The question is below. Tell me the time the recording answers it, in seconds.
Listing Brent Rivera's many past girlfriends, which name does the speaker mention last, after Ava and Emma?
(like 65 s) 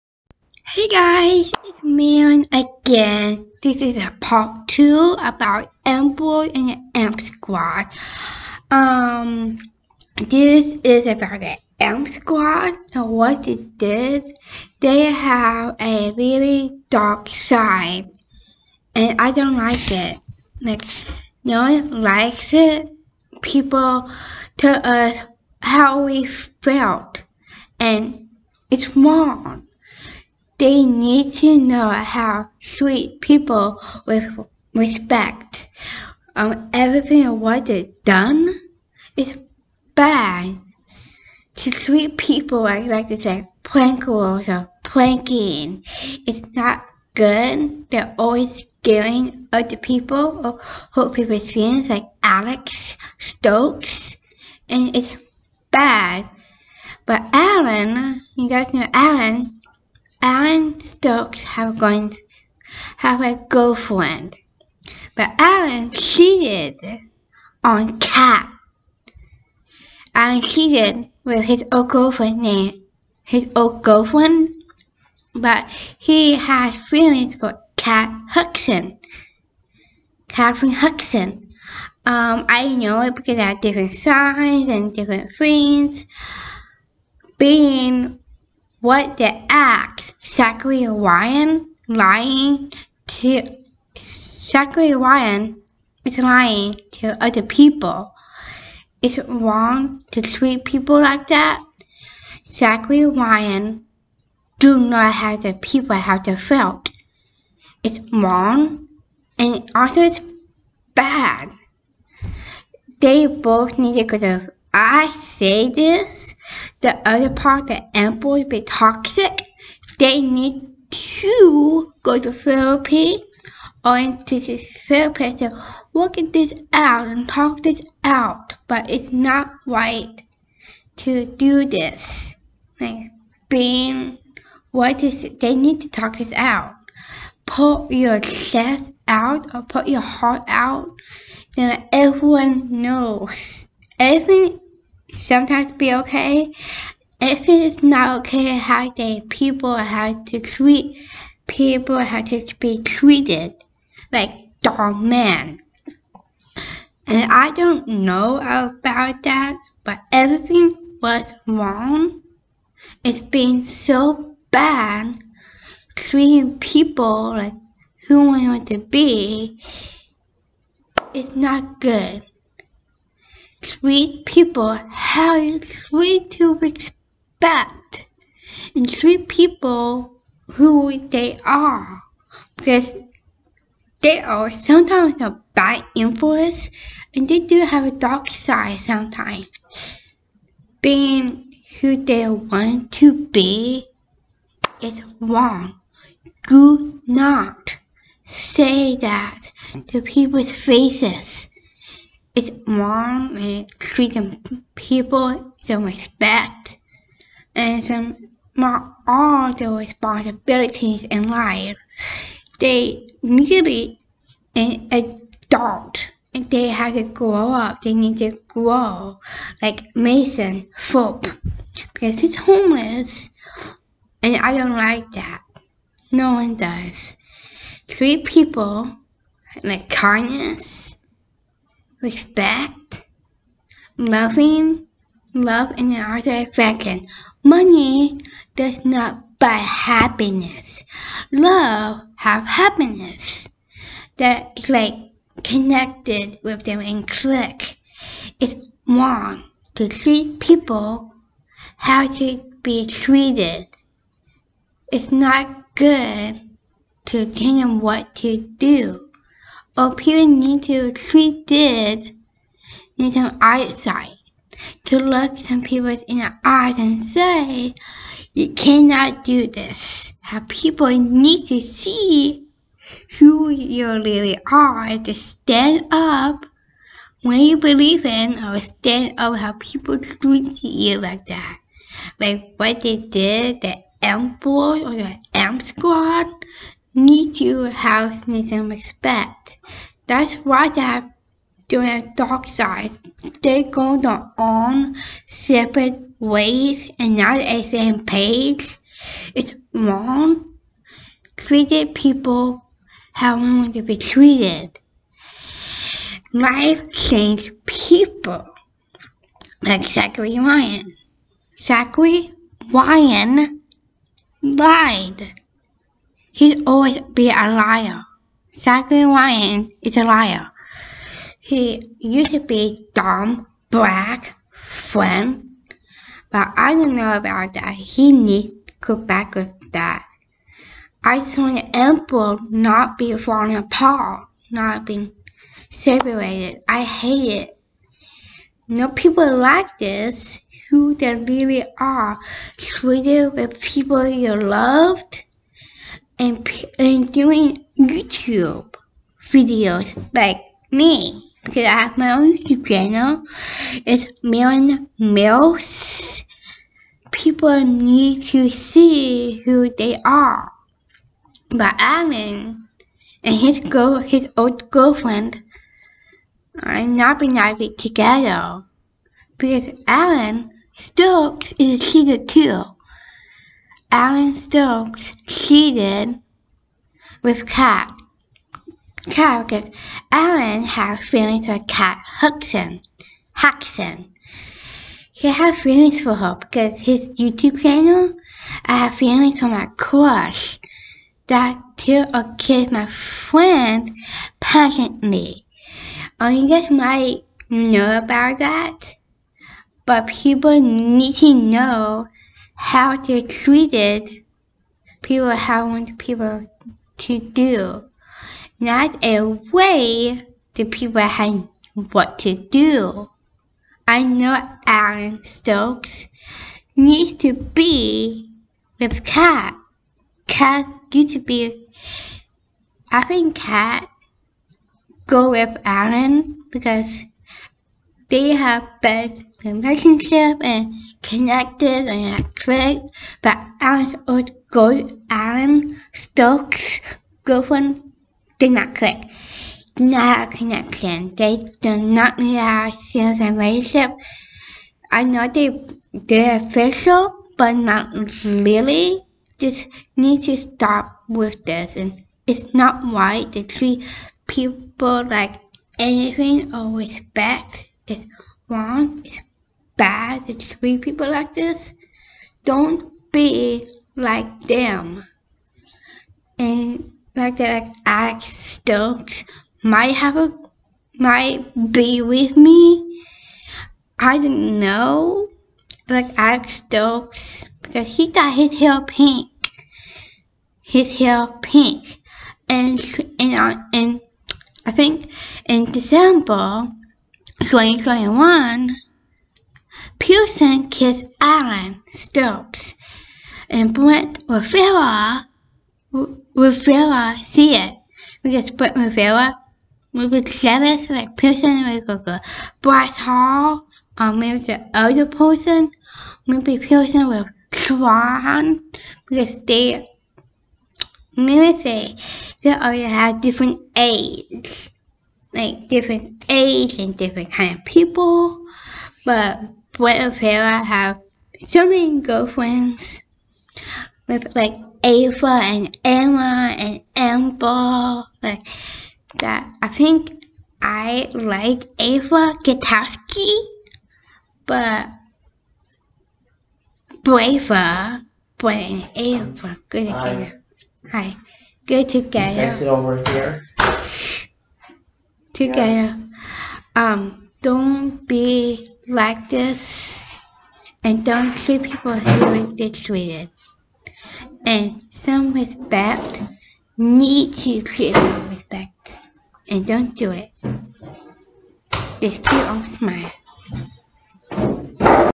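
526 s.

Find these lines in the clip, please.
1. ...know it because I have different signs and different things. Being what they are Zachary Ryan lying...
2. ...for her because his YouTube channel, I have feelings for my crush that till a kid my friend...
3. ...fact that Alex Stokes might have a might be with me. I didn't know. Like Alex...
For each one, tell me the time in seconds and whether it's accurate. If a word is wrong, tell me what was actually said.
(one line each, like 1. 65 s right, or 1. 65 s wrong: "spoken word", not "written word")
1. 82 s right
2. 386 s right
3. 467 s right.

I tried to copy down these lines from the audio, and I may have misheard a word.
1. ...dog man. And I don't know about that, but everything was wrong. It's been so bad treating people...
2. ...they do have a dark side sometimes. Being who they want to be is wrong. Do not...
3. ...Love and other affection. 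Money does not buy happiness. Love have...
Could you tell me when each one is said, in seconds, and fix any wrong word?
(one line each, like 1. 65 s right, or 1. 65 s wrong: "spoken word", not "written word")
1. 154 s right
2. 187 s right
3. 235 s right.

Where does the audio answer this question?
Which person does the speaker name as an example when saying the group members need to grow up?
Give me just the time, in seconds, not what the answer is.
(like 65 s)
219 s.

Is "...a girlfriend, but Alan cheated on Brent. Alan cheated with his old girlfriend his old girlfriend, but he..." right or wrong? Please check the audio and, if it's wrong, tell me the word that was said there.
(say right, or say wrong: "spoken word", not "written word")
wrong: "Kat", not "Brent".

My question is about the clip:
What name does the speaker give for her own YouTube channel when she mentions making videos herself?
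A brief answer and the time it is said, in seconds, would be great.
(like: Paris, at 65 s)
Maren Mills, at 354 s.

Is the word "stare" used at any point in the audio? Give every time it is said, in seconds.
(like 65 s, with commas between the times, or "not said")
not said.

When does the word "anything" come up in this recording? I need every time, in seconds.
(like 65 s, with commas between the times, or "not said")
455 s.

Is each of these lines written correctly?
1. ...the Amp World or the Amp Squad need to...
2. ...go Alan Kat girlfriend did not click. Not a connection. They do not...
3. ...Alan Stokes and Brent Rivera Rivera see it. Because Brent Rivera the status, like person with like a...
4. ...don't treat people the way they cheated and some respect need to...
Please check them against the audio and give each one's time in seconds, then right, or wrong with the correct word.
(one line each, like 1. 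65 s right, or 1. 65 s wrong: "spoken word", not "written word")
1. 283 s right
2. 434 s wrong: "Stokes", not "Kat"
3. 491 s right
4. 551 s wrong: "treated", not "cheated".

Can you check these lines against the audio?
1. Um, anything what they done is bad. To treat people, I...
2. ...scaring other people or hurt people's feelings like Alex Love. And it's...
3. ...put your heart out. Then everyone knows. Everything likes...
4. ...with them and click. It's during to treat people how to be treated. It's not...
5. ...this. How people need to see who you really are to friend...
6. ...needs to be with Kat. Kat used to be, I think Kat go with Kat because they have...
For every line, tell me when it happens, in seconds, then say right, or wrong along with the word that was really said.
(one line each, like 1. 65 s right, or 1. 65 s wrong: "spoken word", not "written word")
1. 36 s wrong: "everything", not "anything"
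2. 48 s wrong: "Stokes", not "Love"
3. 139 s wrong: "sometimes", not "likes"
4. 246 s wrong: "wrong", not "during"
5. 269 s wrong: "stand", not "friend"
6. 416 s wrong: "Alan", not "Kat".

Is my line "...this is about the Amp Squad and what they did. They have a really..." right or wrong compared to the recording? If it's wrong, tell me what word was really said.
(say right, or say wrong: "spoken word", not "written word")
right.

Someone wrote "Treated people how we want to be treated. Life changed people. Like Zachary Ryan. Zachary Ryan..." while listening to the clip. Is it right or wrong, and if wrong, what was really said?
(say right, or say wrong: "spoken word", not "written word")
right.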